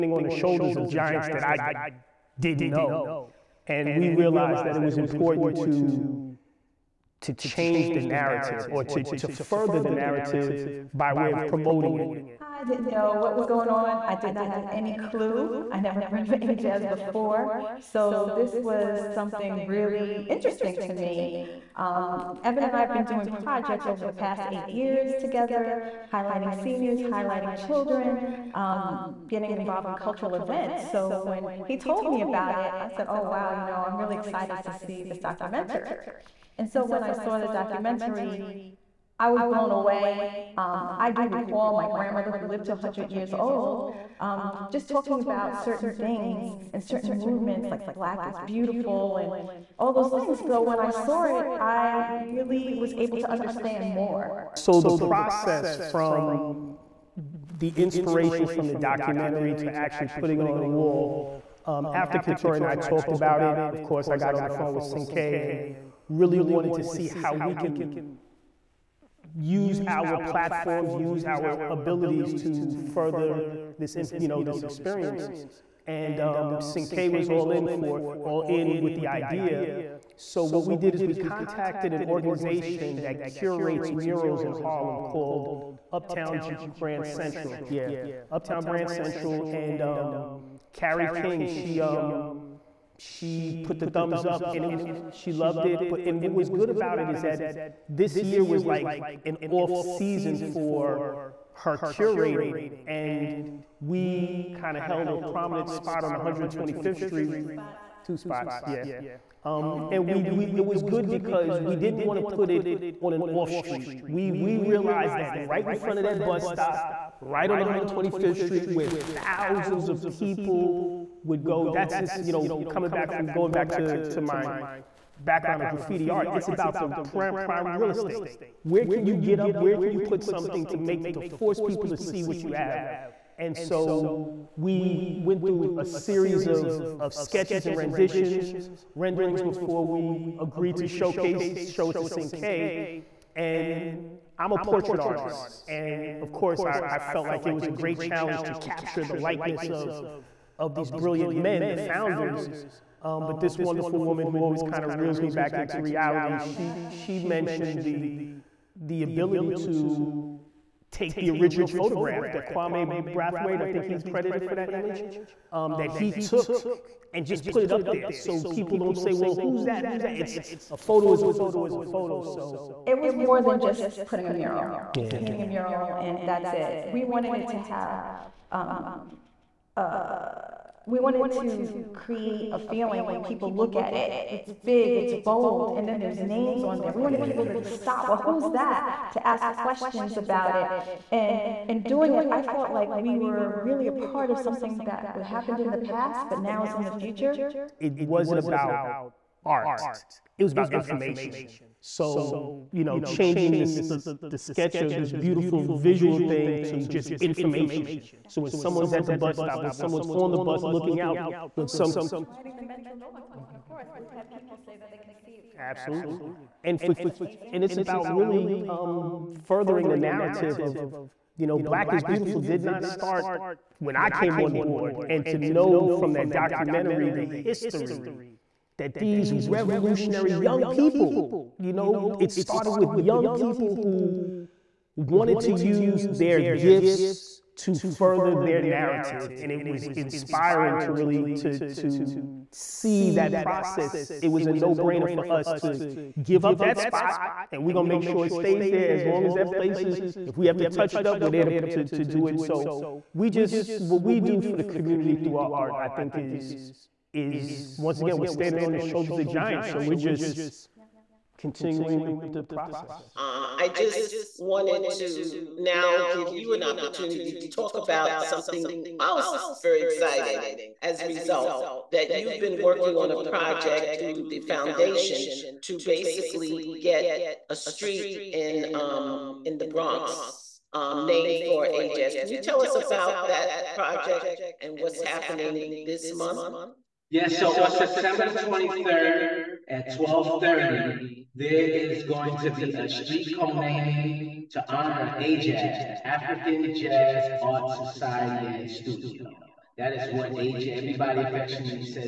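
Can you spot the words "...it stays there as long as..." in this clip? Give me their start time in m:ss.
4:08.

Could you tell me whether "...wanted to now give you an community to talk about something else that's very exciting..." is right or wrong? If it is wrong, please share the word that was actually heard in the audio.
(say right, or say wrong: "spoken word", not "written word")
wrong: "opportunity", not "community".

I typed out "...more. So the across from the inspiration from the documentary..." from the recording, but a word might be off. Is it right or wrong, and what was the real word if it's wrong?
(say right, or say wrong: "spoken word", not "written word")
wrong: "process", not "across".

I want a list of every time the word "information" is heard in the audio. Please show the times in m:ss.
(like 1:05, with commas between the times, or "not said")
3:20, 3:27.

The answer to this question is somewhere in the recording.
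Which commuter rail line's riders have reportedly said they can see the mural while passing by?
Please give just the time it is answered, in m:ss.
3:32.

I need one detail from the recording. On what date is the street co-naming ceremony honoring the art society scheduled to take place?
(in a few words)
September 23.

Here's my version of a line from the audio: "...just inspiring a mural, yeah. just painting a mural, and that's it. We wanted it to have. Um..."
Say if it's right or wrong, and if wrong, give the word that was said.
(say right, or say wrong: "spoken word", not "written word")
wrong: "putting", not "inspiring".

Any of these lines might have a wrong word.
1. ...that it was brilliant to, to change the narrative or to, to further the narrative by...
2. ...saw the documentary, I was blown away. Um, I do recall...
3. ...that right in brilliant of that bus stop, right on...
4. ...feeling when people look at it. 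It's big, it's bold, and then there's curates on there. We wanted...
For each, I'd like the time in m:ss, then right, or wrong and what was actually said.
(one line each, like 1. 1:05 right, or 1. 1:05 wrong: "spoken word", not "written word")
1. 0:04 wrong: "important", not "brilliant"
2. 0:37 right
3. 1:55 wrong: "front", not "brilliant"
4. 3:02 wrong: "names", not "curates".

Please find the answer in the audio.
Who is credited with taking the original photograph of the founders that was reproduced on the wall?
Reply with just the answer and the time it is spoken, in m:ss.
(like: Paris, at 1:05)
Kwame Brathwaite, at 2:42.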